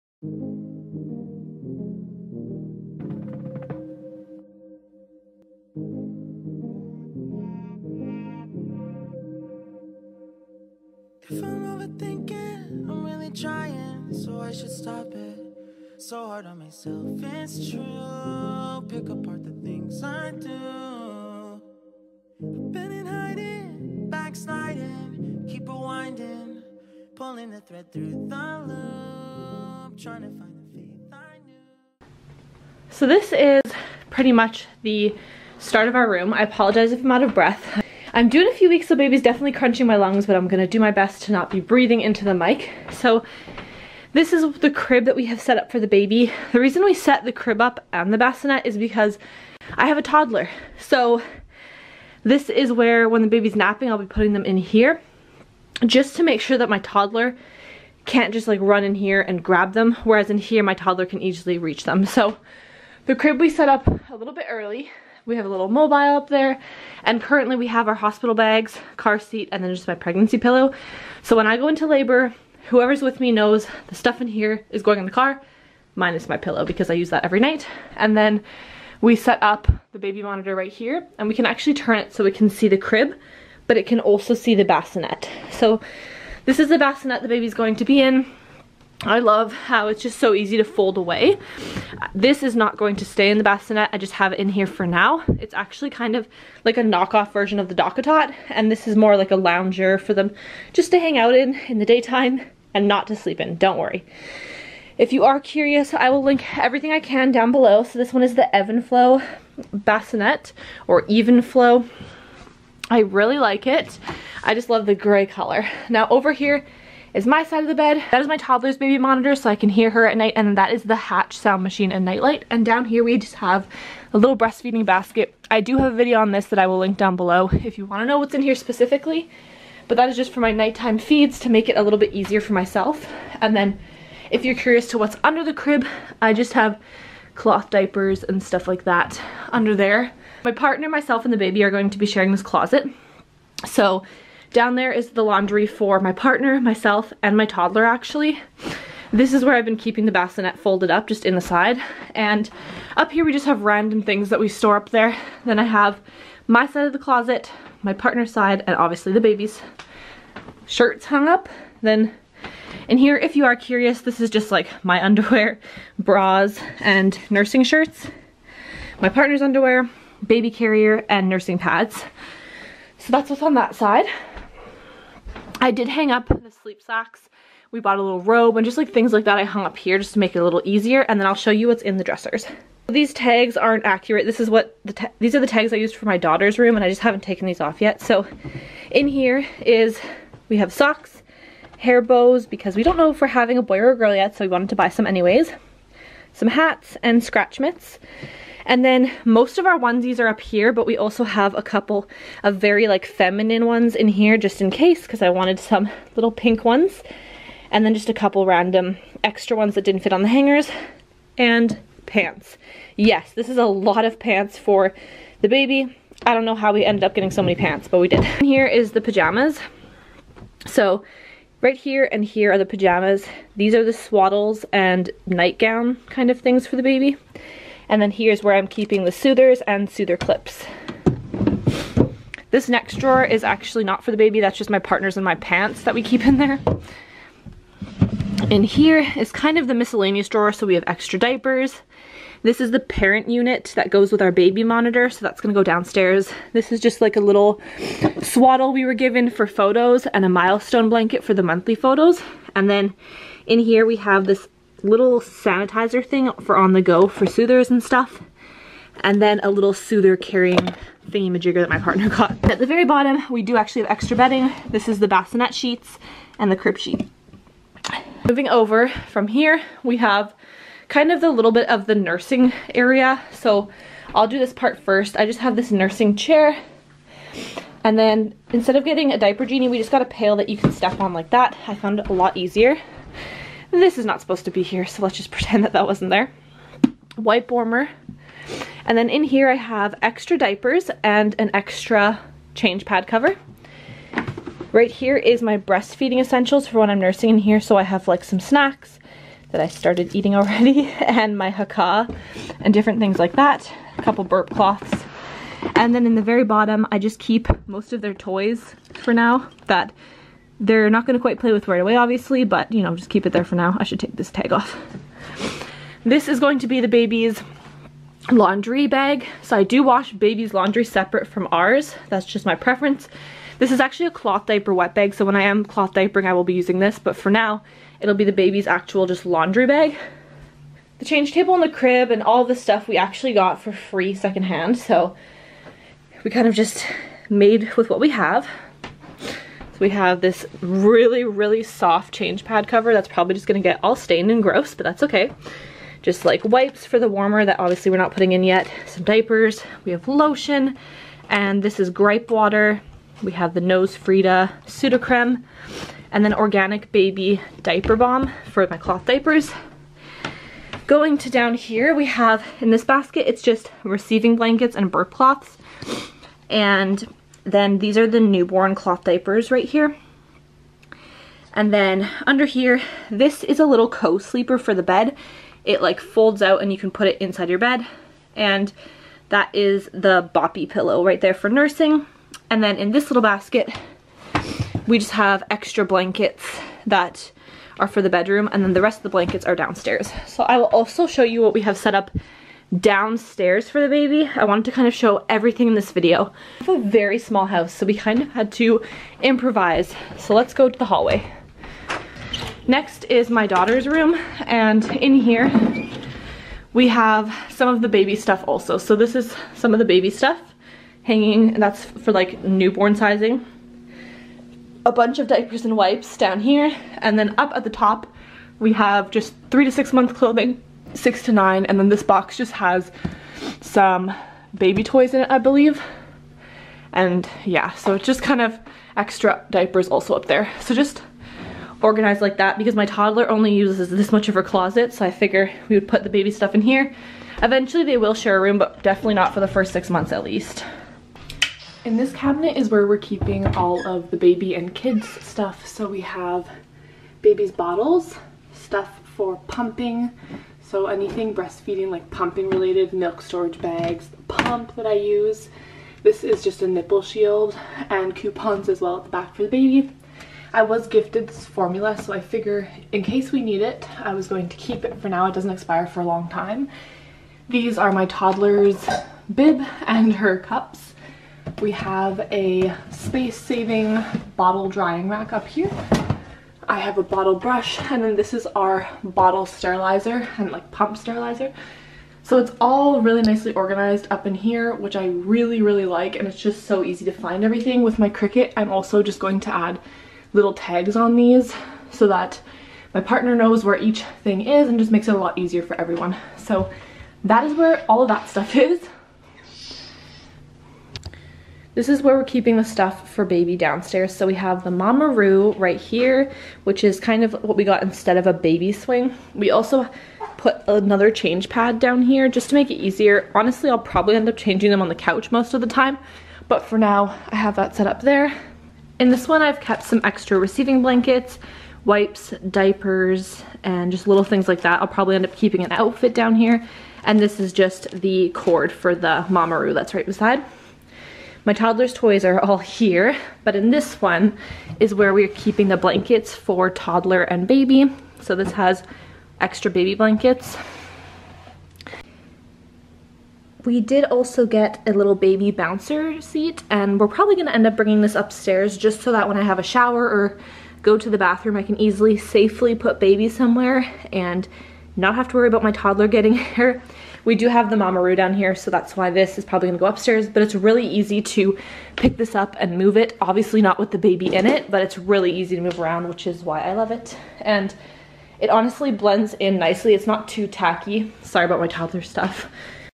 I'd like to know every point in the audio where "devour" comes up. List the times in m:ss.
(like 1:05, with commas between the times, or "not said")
not said.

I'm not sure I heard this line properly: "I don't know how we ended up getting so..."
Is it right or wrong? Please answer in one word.
right.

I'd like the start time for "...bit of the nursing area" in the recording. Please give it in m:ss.
4:31.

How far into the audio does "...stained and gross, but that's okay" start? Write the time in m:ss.
5:43.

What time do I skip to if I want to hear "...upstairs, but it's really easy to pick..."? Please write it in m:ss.
9:19.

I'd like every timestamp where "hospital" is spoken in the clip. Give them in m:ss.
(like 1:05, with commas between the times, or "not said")
1:07.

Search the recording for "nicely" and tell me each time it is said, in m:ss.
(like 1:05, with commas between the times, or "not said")
8:03, 9:29.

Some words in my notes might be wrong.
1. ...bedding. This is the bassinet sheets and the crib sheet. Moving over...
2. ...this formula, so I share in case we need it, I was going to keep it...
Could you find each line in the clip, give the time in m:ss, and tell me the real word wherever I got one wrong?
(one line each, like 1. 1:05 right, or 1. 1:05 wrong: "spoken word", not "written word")
1. 4:24 right
2. 7:41 wrong: "figure", not "share".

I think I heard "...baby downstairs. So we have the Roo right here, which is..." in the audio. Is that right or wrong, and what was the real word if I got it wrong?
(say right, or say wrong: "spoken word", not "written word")
right.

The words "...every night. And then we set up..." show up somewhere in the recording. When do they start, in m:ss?
1:17.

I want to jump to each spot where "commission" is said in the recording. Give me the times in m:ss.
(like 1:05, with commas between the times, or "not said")
not said.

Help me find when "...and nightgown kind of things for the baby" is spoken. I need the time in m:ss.
3:44.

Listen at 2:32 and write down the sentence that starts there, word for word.
And up here we just have random things that we store up there.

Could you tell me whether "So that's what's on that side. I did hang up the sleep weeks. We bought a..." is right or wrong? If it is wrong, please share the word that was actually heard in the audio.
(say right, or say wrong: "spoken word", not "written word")
wrong: "socks", not "weeks".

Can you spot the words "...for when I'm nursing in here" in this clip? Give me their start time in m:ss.
4:56.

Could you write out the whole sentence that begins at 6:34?
I wanted to kind of show everything in this video.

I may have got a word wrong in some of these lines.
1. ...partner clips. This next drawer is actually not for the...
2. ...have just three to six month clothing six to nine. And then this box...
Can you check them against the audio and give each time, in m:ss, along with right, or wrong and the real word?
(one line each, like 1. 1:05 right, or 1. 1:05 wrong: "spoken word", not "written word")
1. 3:49 wrong: "soother", not "partner"
2. 6:58 right.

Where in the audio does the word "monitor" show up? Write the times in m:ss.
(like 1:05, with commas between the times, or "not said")
1:20, 1:58, 4:04.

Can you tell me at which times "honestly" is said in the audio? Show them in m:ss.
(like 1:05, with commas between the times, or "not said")
8:33, 9:28.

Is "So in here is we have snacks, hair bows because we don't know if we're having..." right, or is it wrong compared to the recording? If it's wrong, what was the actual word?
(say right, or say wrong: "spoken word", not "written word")
wrong: "socks", not "snacks".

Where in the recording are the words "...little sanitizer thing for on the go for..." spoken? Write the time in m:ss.
4:14.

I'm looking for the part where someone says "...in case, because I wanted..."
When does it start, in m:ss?
3:24.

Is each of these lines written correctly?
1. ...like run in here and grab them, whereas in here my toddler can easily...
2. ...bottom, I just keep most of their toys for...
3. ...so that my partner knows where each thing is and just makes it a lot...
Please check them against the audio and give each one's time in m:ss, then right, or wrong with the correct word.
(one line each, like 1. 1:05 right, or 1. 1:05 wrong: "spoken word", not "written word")
1. 0:58 right
2. 5:06 right
3. 8:11 right.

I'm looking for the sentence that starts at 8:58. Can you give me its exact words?
So this has extra baby blankets.